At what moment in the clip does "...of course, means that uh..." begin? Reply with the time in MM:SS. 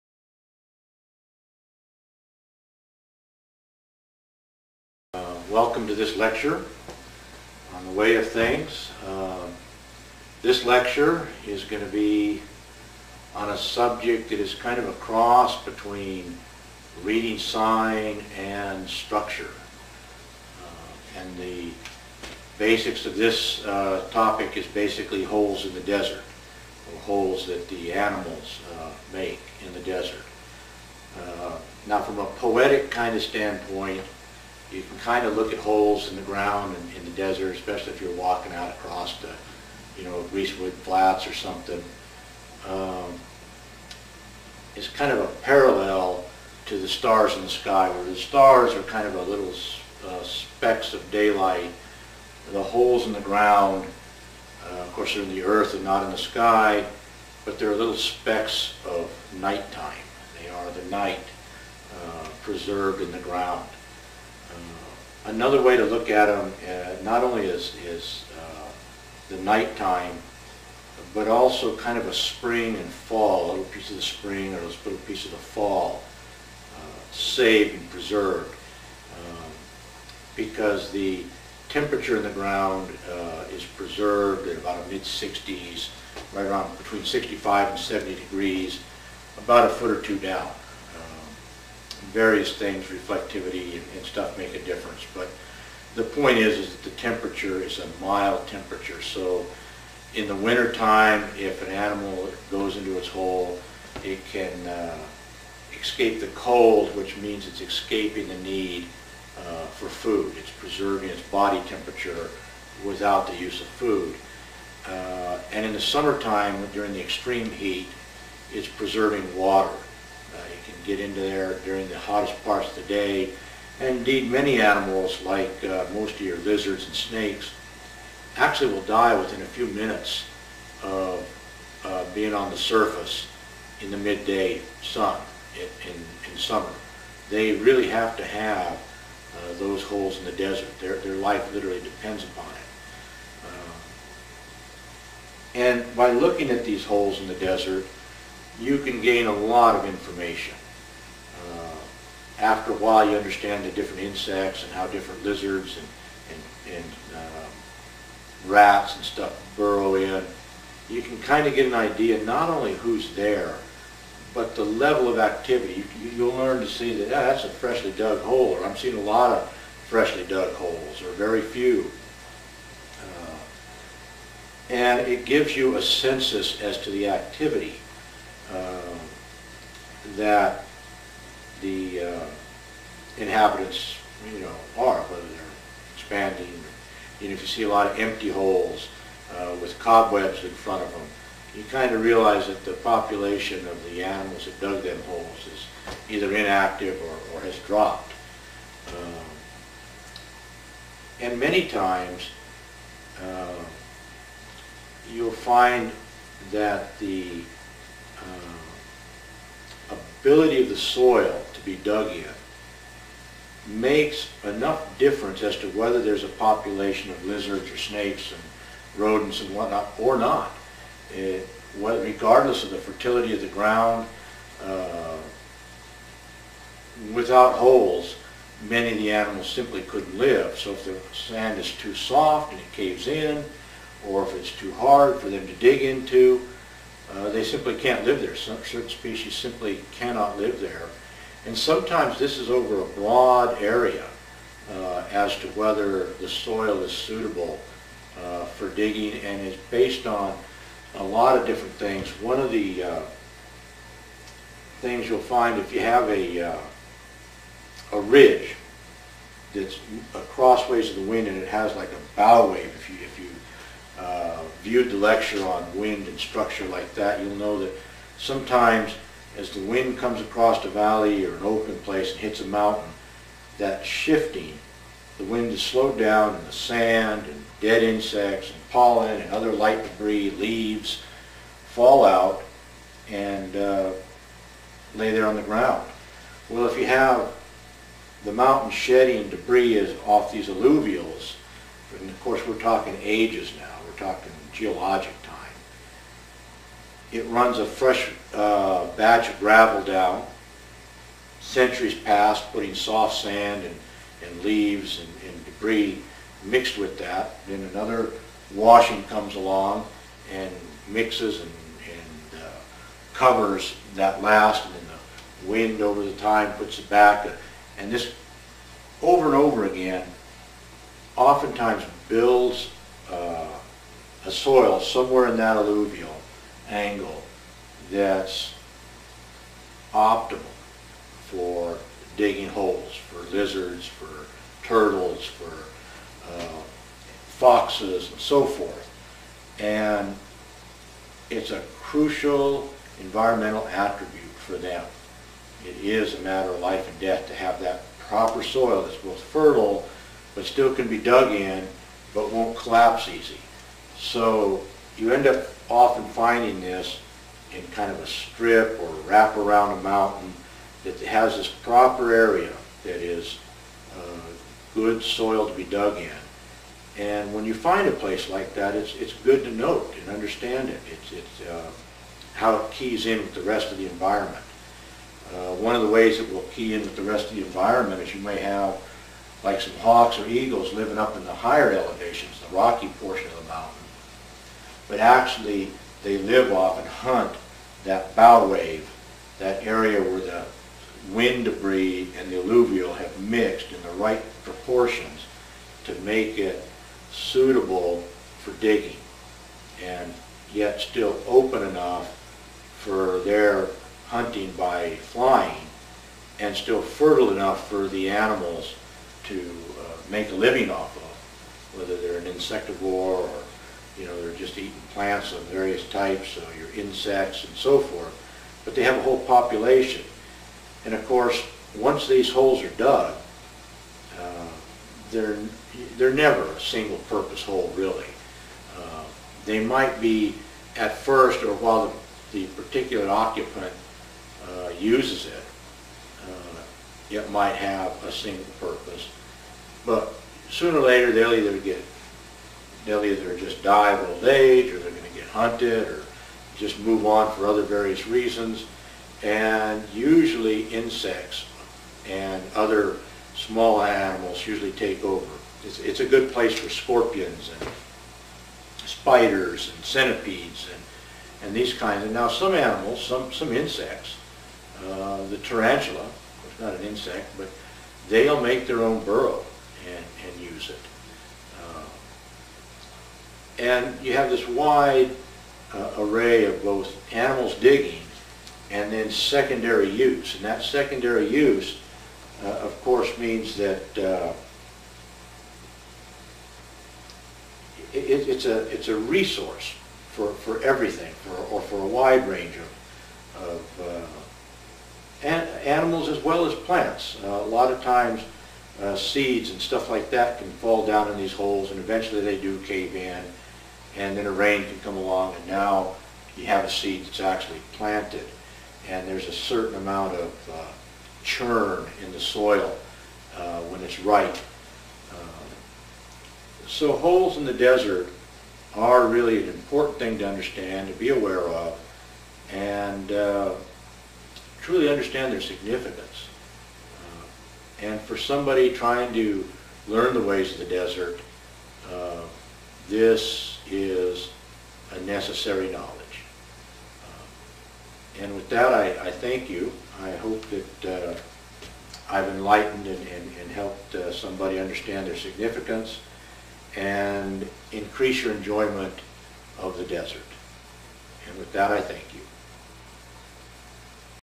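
08:02.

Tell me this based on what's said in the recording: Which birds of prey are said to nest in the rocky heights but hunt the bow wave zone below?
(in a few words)
Hawks or eagles.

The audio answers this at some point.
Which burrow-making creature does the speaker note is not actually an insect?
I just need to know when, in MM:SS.
07:45.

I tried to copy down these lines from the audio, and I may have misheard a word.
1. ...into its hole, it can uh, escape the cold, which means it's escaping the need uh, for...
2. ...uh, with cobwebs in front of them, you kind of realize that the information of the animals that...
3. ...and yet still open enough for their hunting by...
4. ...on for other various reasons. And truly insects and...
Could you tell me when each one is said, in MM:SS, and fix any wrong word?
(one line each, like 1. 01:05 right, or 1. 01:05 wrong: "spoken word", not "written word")
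1. 01:42 right
2. 03:09 wrong: "population", not "information"
3. 06:39 right
4. 07:27 wrong: "usually", not "truly".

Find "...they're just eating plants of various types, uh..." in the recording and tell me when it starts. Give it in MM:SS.
06:54.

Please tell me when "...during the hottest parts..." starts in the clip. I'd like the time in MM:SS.
02:01.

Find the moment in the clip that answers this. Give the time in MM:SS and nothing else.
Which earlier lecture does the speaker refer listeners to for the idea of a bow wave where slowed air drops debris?
04:25.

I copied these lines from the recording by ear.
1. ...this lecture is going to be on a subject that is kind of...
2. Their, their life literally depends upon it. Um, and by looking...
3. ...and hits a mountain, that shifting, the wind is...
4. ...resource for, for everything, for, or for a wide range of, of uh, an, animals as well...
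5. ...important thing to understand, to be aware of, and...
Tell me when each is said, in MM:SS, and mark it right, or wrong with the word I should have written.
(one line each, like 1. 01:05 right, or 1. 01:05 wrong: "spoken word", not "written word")
1. 00:10 right
2. 02:20 right
3. 04:32 right
4. 08:08 right
5. 08:39 right.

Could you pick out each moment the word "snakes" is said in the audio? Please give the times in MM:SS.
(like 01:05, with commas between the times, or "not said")
02:06, 03:37.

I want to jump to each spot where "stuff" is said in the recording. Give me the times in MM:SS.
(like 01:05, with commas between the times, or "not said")
01:34, 02:39, 08:19.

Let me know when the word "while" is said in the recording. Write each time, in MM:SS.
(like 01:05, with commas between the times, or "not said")
02:32, 07:11.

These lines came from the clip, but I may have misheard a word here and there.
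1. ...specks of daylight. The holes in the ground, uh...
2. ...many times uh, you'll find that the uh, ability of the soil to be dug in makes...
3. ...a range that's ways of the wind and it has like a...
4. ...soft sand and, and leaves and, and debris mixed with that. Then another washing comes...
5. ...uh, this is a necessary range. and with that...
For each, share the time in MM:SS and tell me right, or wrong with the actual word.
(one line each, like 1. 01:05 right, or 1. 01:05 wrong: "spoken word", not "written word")
1. 00:50 right
2. 03:21 right
3. 04:17 wrong: "ridge", not "range"
4. 05:02 right
5. 08:51 wrong: "knowledge", not "range".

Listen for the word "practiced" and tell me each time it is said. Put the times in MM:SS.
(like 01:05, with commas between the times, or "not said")
not said.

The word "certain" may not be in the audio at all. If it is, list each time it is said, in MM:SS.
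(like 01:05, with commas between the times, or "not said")
03:58, 08:29.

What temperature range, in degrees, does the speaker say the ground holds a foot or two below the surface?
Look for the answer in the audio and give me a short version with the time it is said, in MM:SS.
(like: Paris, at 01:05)
65 to 70 degrees, at 01:26.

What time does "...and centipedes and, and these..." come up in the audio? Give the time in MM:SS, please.
07:39.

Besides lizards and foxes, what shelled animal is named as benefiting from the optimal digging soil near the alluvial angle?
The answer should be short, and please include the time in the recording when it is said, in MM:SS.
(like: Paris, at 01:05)
Turtles, at 05:34.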